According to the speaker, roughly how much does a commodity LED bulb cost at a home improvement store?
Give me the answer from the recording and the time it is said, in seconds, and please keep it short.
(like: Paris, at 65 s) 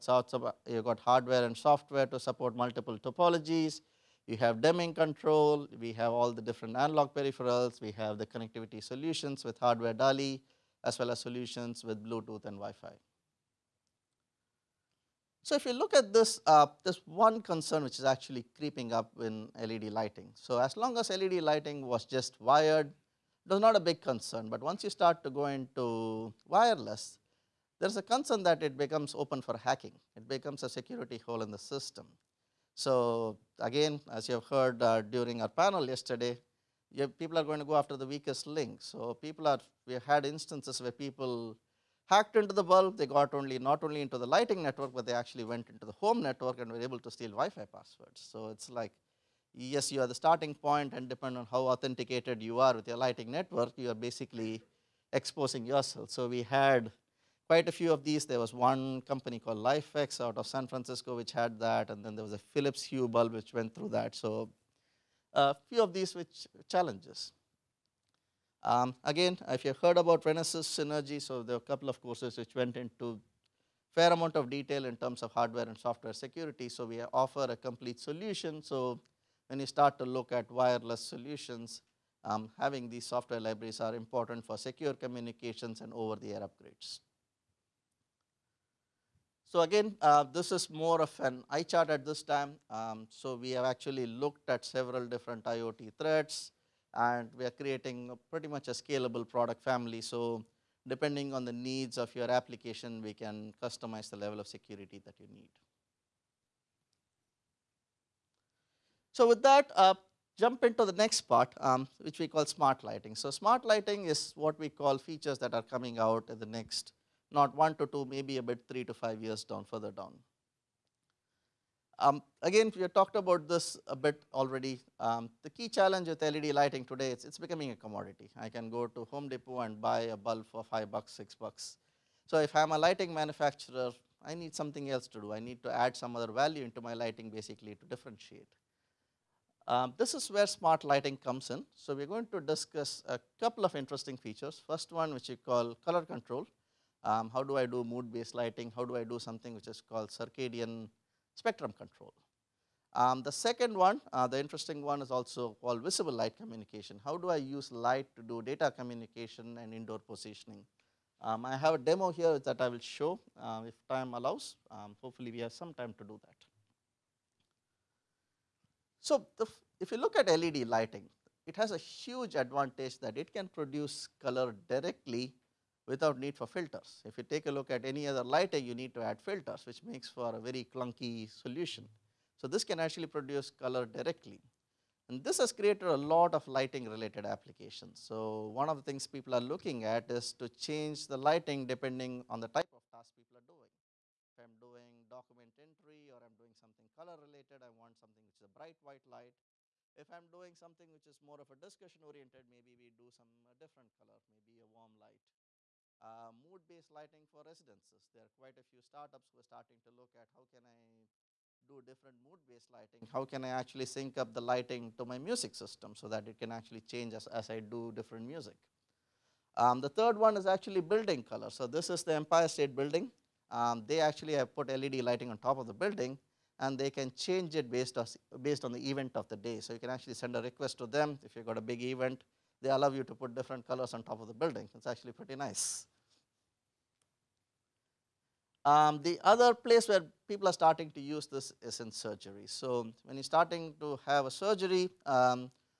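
5 or 6 dollars, at 130 s.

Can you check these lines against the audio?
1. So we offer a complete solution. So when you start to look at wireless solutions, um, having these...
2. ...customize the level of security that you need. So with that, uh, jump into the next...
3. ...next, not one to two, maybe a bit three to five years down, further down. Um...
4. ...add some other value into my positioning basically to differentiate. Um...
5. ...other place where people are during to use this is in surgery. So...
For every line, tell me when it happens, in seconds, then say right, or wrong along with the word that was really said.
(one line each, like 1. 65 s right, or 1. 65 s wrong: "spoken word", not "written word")
1. 76 s right
2. 103 s right
3. 116 s right
4. 135 s wrong: "lighting", not "positioning"
5. 239 s wrong: "starting", not "during".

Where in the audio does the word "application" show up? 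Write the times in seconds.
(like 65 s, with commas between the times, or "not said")
102 s, 187 s.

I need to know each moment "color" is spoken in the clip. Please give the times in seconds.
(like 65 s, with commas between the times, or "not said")
145 s, 174 s, 183 s, 196 s, 203 s, 221 s, 233 s.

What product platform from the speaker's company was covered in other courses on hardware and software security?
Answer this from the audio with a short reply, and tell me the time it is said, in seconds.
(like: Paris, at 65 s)
Renesas Synergy, at 70 s.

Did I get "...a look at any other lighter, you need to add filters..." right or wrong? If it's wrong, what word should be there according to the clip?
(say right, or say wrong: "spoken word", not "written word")
right.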